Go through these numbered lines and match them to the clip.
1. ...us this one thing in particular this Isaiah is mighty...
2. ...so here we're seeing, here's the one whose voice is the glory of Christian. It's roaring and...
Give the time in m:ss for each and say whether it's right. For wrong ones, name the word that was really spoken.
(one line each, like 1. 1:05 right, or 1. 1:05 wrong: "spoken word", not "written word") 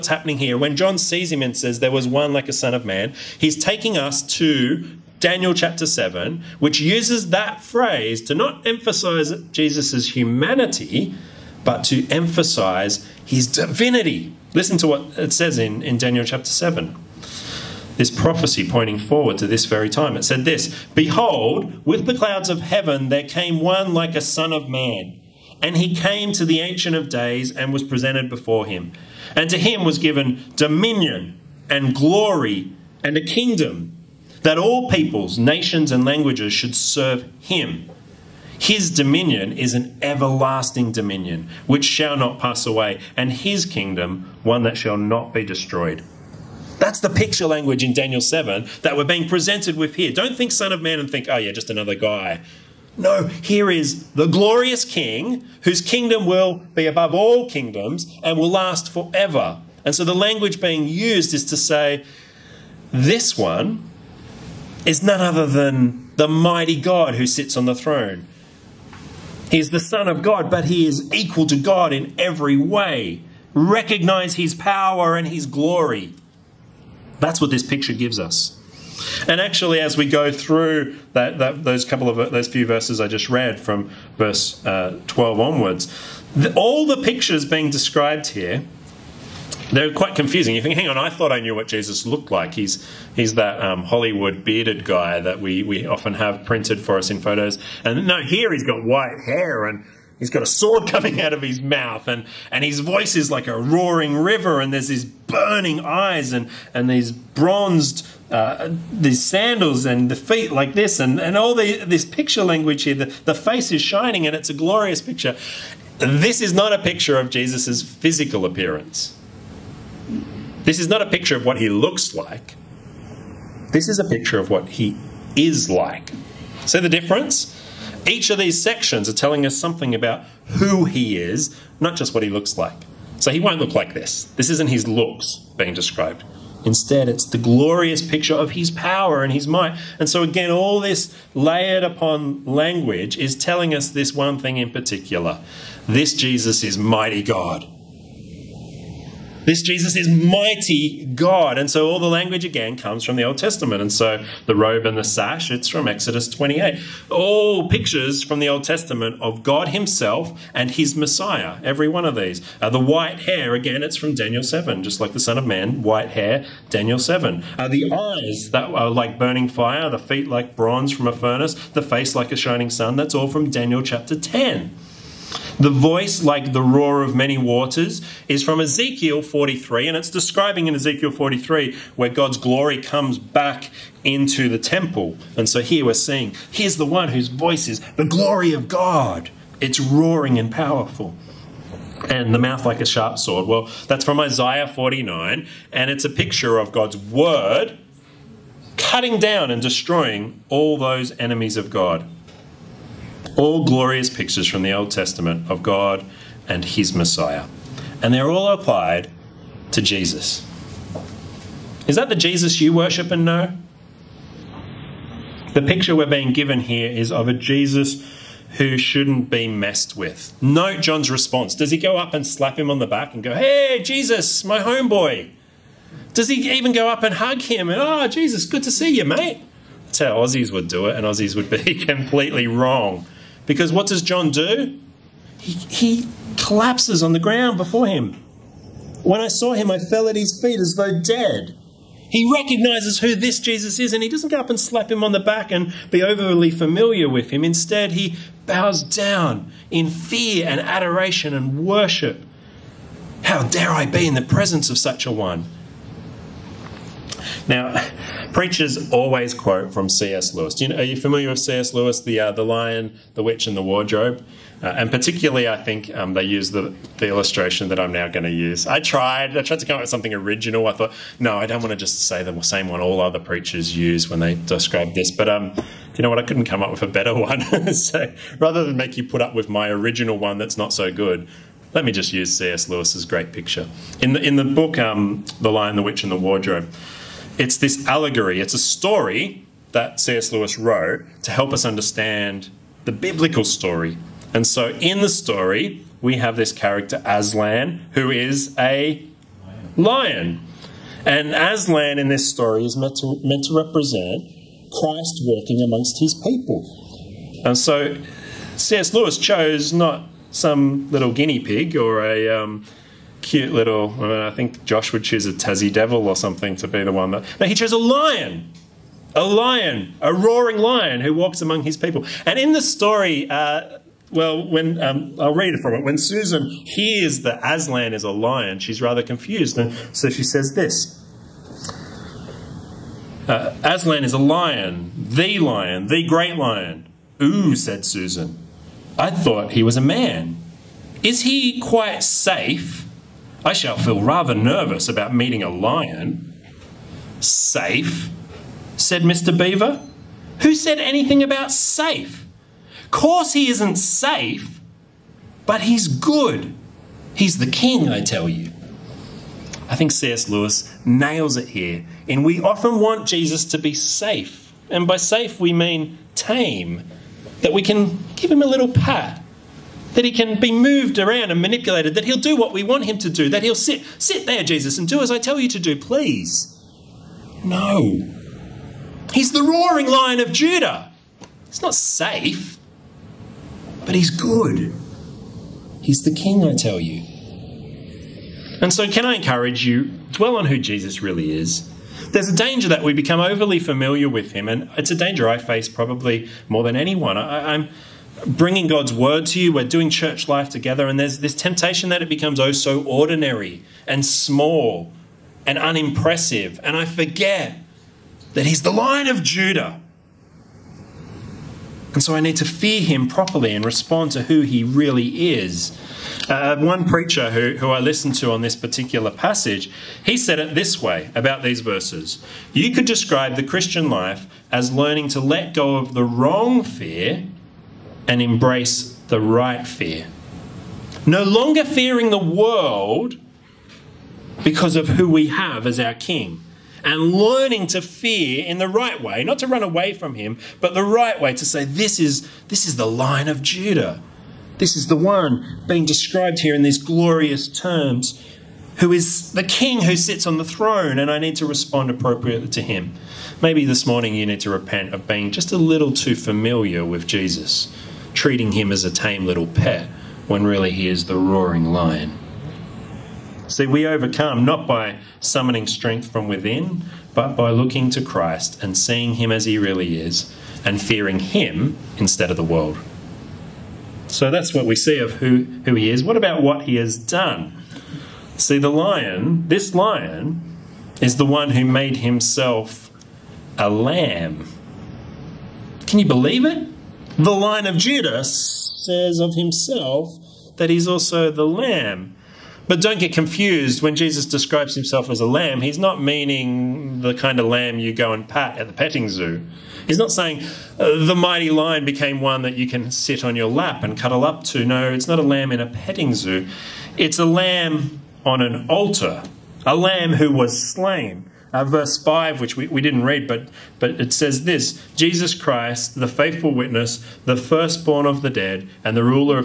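1. 2:23 wrong: "Jesus", not "Isaiah"
2. 3:05 wrong: "God", not "Christian".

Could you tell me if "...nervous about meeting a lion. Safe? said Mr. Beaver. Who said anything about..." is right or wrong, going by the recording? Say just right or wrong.
right.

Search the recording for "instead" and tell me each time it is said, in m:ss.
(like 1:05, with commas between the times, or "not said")
2:16, 4:07, 7:51.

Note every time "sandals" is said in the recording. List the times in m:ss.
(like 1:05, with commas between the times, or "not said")
1:49.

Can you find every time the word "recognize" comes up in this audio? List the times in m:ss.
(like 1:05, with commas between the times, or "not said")
1:13, 4:02.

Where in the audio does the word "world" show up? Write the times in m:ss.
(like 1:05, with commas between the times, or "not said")
7:12, 7:52.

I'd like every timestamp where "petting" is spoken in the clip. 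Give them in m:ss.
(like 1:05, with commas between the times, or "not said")
8:18, 8:25.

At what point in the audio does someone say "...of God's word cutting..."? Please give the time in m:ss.
3:16.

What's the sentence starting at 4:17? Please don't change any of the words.
Now, preachers always quote from C.S.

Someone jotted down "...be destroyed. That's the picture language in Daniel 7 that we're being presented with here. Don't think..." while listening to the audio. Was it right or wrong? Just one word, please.
right.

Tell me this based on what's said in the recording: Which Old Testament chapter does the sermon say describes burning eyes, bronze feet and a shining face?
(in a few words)
Daniel chapter 10.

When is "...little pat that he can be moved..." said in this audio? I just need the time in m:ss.
6:08.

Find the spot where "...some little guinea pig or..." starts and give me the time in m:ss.
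5:10.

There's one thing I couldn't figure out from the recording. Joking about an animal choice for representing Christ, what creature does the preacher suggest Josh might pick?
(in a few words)
Tassie Devil.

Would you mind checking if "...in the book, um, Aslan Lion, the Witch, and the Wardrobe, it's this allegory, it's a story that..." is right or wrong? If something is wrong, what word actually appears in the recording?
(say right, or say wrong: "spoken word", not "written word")
wrong: "The", not "Aslan".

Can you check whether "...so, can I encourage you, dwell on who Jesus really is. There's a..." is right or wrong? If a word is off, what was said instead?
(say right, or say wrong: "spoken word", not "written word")
right.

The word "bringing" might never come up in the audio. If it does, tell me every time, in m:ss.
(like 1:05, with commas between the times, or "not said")
6:38.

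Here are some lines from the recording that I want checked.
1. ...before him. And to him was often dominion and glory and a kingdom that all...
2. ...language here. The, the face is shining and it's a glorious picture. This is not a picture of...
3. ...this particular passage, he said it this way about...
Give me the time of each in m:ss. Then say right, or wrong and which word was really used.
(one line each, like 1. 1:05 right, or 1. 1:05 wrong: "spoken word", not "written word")
1. 0:28 wrong: "given", not "often"
2. 1:52 right
3. 6:58 right.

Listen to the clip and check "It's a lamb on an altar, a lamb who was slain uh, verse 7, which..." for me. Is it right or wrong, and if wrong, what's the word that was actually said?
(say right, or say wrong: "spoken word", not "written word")
wrong: "5", not "7".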